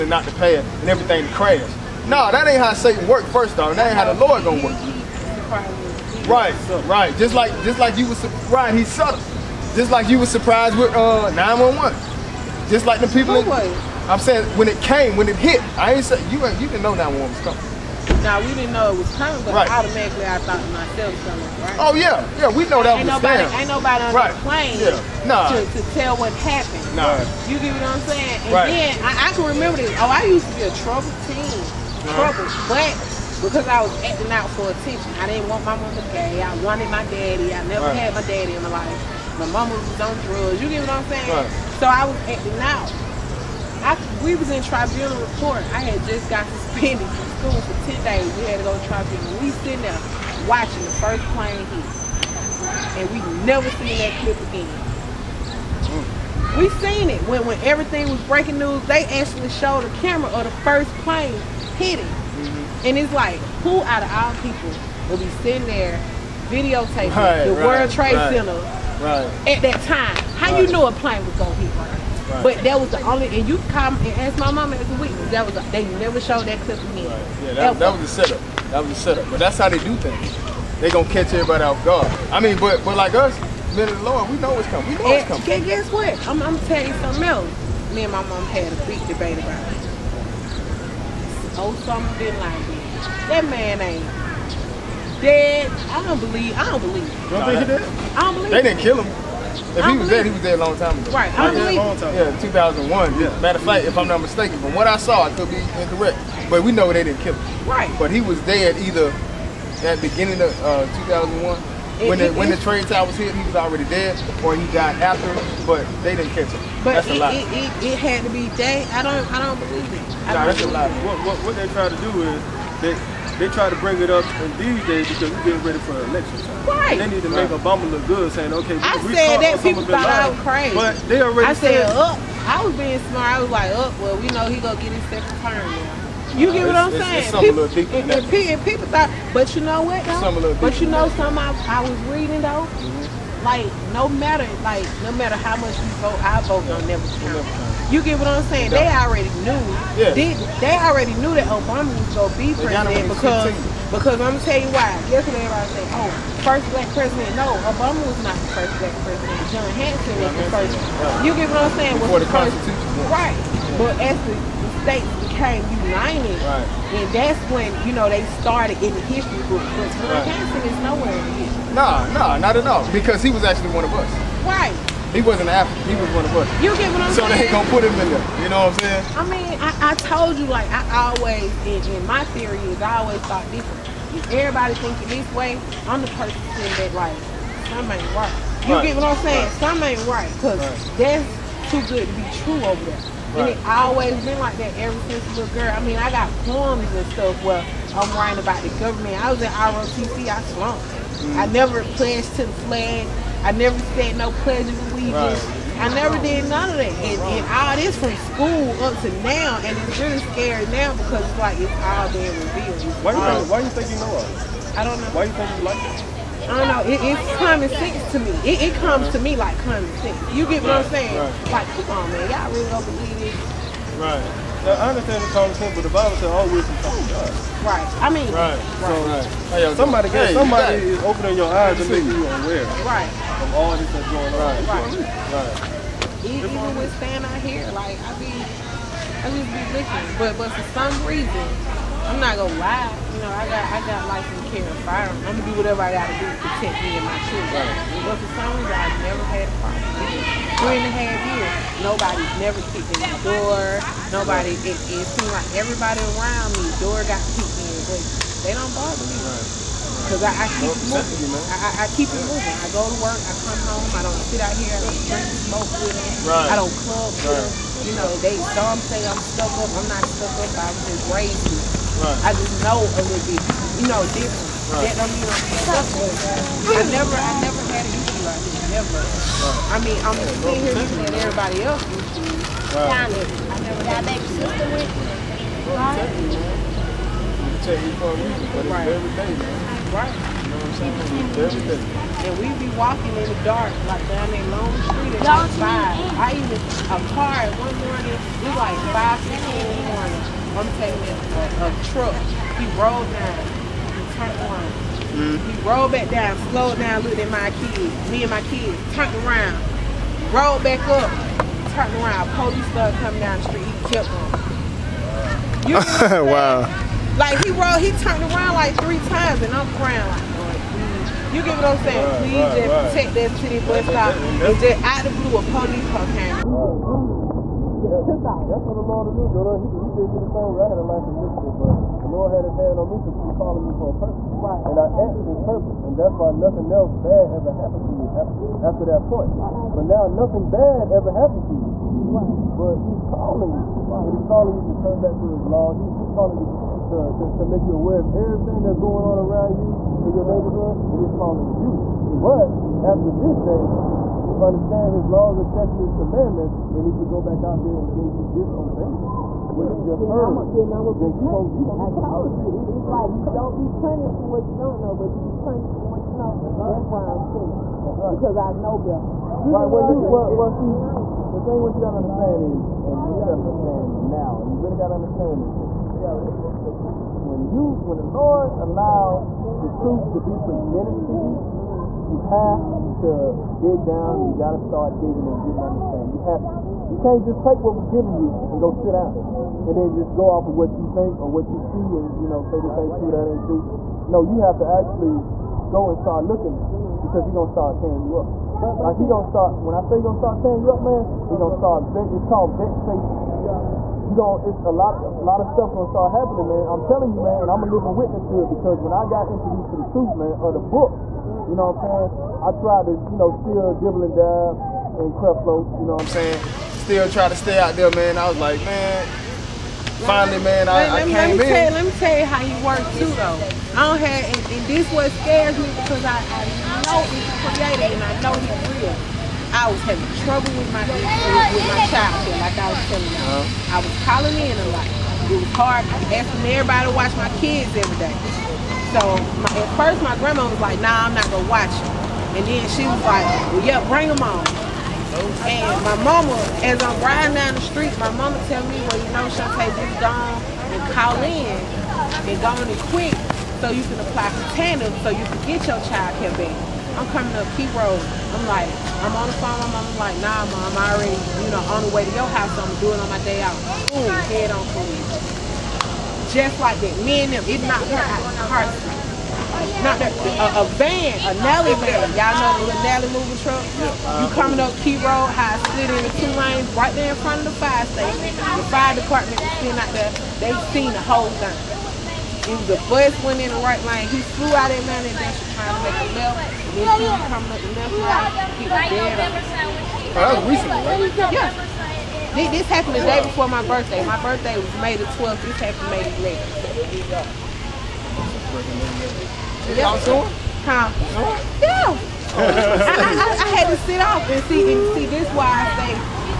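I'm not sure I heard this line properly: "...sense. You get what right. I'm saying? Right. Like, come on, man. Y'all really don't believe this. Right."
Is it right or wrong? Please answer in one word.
right.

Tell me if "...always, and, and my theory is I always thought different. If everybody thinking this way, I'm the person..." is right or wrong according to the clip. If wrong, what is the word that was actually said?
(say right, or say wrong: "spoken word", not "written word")
right.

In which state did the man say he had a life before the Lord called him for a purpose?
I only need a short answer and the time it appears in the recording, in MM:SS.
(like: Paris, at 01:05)
Michigan, at 05:31.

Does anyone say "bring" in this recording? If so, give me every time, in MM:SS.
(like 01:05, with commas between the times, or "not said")
02:03, 07:23.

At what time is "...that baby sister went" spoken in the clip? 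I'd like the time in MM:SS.
04:43.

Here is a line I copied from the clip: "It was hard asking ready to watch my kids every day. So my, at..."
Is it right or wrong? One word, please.
wrong.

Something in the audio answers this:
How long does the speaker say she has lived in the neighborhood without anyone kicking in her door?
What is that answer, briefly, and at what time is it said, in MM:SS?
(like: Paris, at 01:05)
three and a half years, at 04:10.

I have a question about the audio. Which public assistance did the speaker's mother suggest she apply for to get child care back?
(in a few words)
tandem.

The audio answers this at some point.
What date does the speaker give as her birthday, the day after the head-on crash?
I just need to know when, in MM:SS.
08:14.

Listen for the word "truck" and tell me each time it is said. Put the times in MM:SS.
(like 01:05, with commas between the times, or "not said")
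05:01, 07:53.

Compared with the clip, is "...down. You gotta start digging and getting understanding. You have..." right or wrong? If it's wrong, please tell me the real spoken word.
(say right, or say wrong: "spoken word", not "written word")
right.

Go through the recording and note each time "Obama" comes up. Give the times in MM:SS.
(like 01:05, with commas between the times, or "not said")
02:07, 02:31, 02:37.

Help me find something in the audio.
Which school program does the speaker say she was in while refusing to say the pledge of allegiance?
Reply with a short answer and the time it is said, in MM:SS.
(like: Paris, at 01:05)
ROTC, at 03:19.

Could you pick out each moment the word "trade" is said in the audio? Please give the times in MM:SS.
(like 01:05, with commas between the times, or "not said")
01:07, 01:52.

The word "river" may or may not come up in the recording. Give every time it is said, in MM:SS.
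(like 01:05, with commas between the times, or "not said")
not said.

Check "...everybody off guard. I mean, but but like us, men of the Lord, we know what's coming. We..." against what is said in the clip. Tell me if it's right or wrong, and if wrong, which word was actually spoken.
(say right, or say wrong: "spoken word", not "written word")
right.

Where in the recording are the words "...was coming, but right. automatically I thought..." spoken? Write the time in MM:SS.
00:18.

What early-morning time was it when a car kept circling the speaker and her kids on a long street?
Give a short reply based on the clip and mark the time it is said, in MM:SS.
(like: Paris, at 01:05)
5:15, at 04:58.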